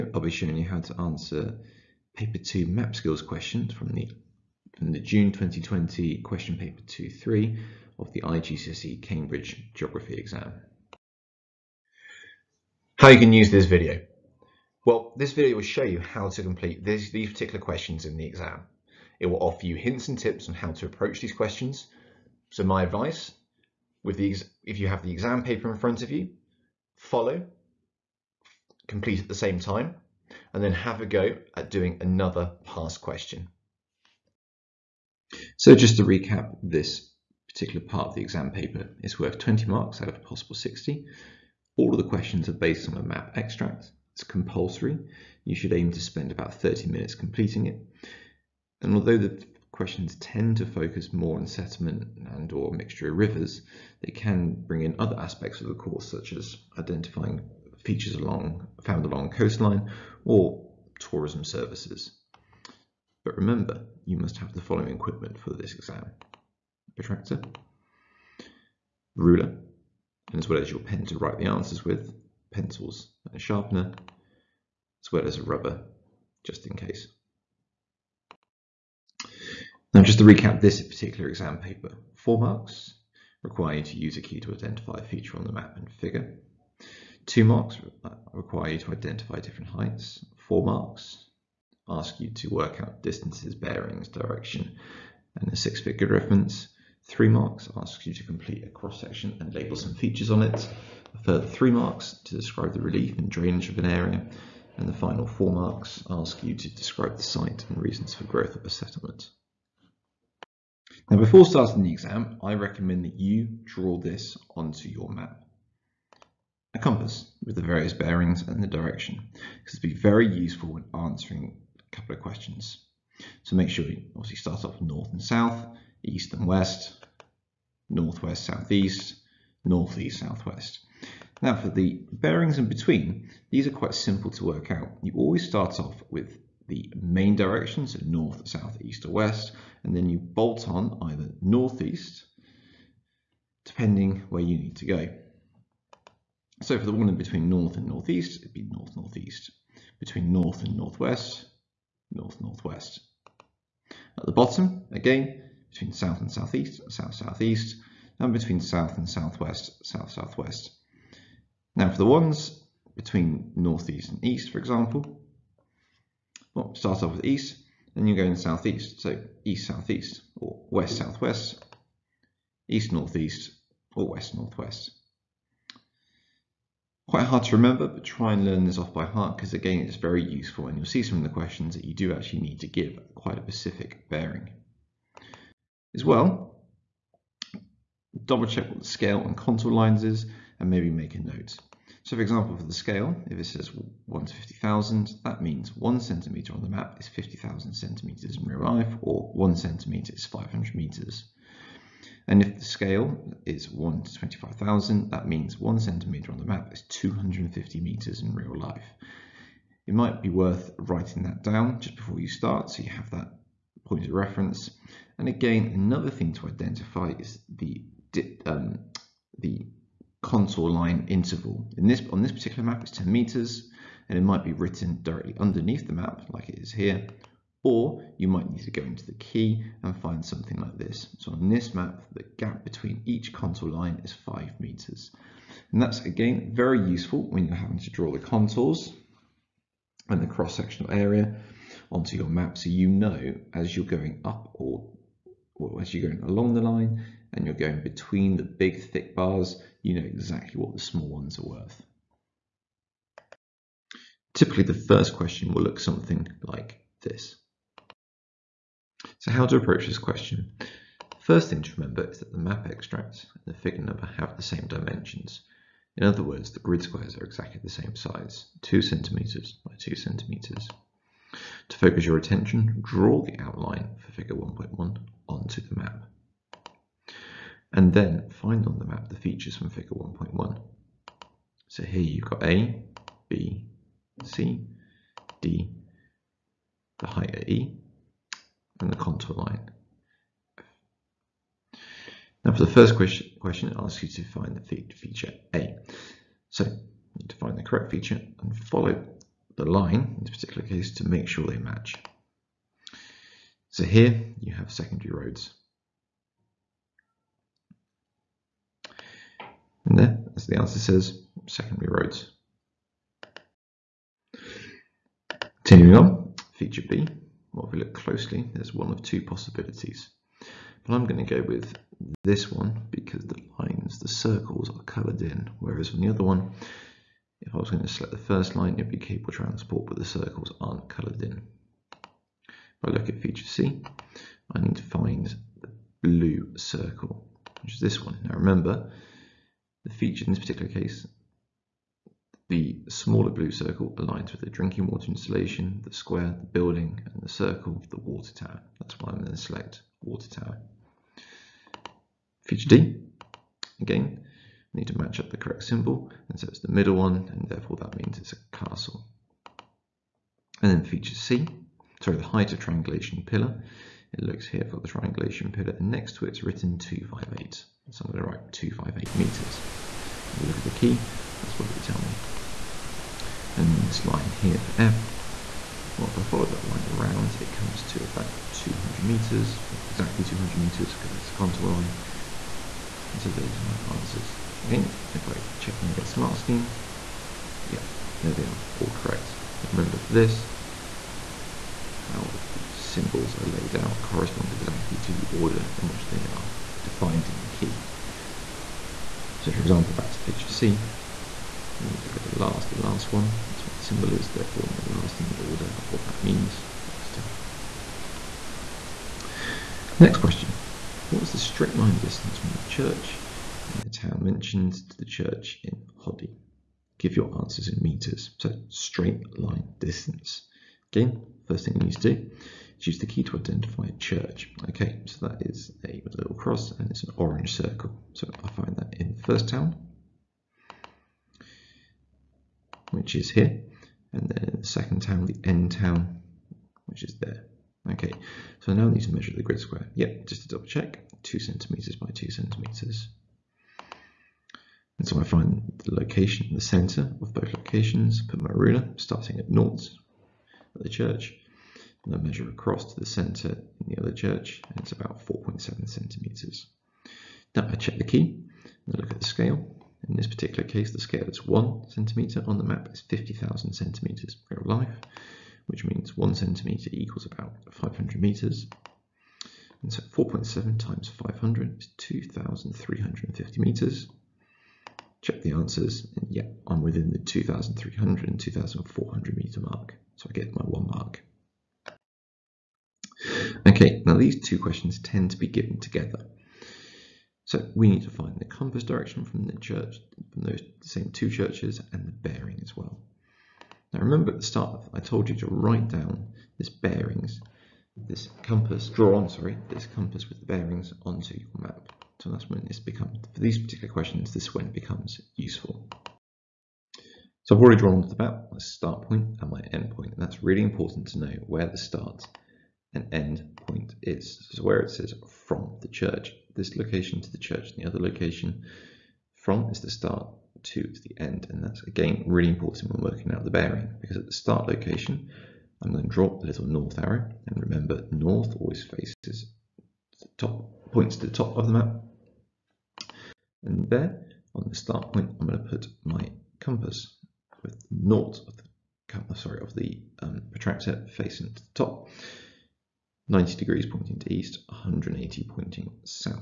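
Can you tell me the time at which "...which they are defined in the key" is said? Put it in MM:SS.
06:35.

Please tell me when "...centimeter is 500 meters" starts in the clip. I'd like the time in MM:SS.
03:19.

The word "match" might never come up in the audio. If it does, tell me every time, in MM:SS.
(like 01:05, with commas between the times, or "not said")
05:01, 05:54.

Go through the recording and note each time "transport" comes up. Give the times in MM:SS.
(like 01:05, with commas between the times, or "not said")
05:29.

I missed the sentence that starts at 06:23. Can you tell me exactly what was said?
And so those are my answers.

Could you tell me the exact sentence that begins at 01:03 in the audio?
But remember, you must have the following equipment for this exam.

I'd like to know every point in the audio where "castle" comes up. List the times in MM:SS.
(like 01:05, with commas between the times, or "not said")
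05:58.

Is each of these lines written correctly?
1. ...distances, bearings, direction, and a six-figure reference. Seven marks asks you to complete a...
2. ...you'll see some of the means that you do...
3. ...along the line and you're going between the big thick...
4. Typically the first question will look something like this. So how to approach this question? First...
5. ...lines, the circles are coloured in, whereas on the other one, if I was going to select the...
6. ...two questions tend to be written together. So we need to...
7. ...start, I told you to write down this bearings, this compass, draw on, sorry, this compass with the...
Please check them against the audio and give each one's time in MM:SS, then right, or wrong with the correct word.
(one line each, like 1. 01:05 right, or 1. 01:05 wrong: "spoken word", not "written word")
1. 01:33 wrong: "Three", not "Seven"
2. 03:00 wrong: "questions", not "means"
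3. 04:06 right
4. 04:14 right
5. 05:23 right
6. 08:04 wrong: "given", not "written"
7. 08:14 right.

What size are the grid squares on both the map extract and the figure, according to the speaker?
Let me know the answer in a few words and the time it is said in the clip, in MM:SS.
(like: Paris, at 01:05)
2 cm by 2 cm, at 04:28.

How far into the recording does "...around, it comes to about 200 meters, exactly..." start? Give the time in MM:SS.
06:16.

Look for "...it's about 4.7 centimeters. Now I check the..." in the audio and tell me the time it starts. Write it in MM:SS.
07:34.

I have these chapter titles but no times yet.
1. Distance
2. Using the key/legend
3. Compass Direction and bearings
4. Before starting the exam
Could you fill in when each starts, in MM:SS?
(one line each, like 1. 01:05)
1. 06:34
2. 04:13
3. 08:11
4. 01:49.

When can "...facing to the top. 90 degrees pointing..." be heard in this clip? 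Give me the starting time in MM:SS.
09:01.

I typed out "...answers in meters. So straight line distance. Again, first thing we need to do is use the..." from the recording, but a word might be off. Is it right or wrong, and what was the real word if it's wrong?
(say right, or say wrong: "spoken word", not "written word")
right.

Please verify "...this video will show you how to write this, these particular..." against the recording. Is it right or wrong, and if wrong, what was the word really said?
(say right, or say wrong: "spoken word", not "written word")
wrong: "complete", not "write".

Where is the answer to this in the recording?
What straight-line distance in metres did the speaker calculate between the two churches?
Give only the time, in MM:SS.
07:51.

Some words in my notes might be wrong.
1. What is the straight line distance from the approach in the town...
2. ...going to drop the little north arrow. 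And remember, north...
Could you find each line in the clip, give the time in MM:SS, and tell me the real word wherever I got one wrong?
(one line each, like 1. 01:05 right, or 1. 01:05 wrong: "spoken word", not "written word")
1. 06:51 wrong: "church", not "approach"
2. 08:45 right.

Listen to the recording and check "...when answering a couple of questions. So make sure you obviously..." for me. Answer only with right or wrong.
right.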